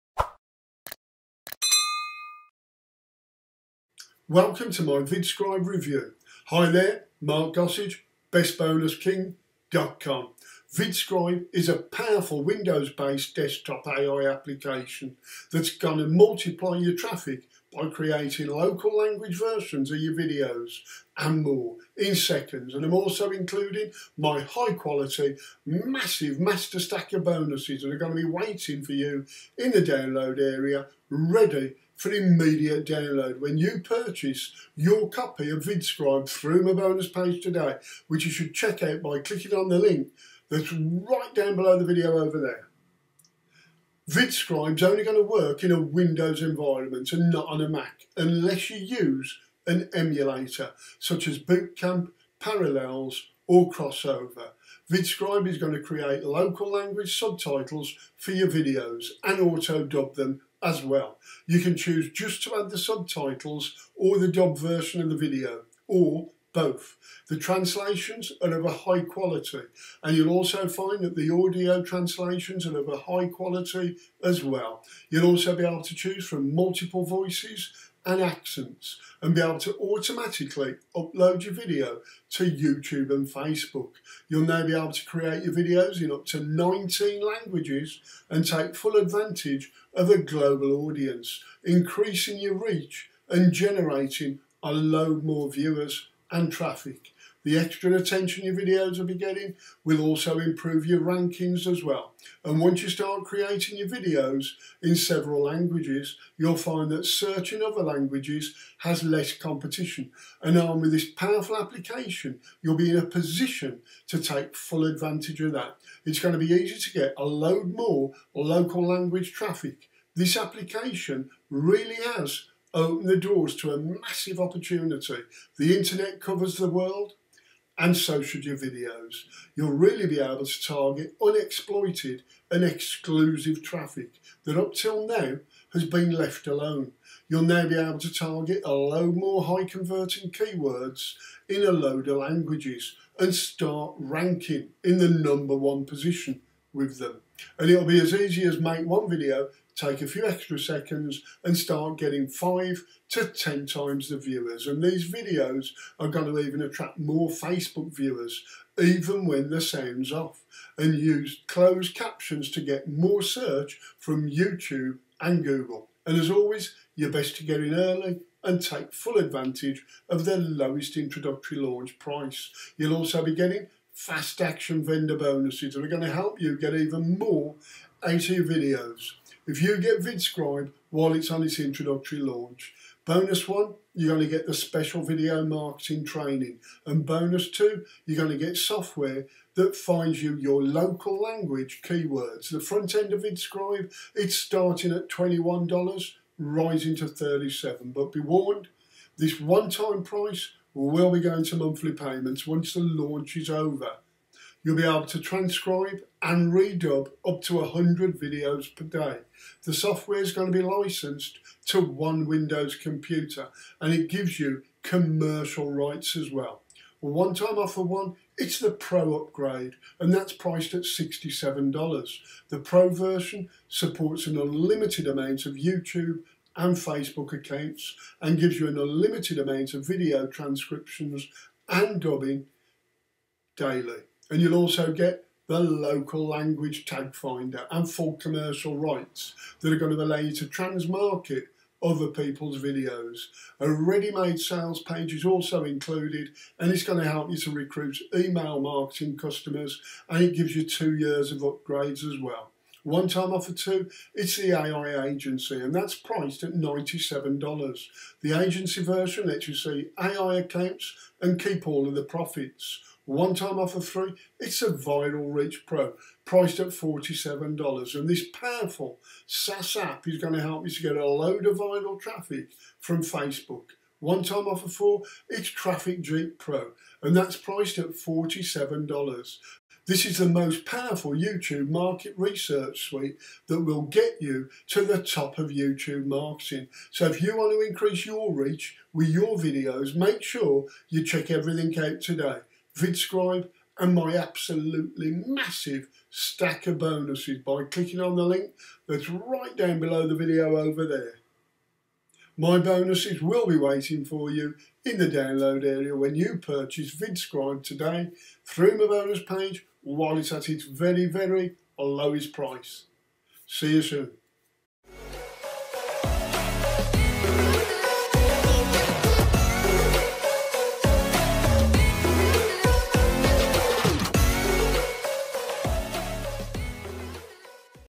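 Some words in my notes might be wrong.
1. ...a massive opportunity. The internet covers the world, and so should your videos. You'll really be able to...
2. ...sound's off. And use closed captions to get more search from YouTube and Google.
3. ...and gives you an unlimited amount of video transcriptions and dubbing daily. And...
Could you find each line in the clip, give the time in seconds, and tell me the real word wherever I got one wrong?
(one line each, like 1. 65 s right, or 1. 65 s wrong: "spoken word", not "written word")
1. 123 s right
2. 159 s right
3. 228 s right.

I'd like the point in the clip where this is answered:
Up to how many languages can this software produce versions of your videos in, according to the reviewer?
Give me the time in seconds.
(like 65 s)
86 s.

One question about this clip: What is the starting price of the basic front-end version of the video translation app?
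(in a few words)
$21.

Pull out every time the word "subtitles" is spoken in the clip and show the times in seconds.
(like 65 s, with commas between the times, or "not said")
57 s, 62 s.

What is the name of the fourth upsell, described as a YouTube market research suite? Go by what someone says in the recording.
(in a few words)
Traffic Jeep Pro.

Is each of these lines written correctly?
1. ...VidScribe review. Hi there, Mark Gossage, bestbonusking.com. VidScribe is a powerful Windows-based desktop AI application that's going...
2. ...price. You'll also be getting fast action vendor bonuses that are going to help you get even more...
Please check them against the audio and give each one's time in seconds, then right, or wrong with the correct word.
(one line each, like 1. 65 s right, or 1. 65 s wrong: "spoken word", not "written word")
1. 4 s right
2. 171 s right.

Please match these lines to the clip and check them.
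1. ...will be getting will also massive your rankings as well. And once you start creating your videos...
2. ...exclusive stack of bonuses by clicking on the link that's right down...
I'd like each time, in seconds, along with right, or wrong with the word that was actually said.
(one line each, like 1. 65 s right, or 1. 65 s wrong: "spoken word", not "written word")
1. 98 s wrong: "improve", not "massive"
2. 295 s wrong: "massive", not "exclusive".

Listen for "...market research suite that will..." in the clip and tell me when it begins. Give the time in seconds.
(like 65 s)
281 s.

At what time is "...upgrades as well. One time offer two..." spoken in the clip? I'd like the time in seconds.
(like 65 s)
251 s.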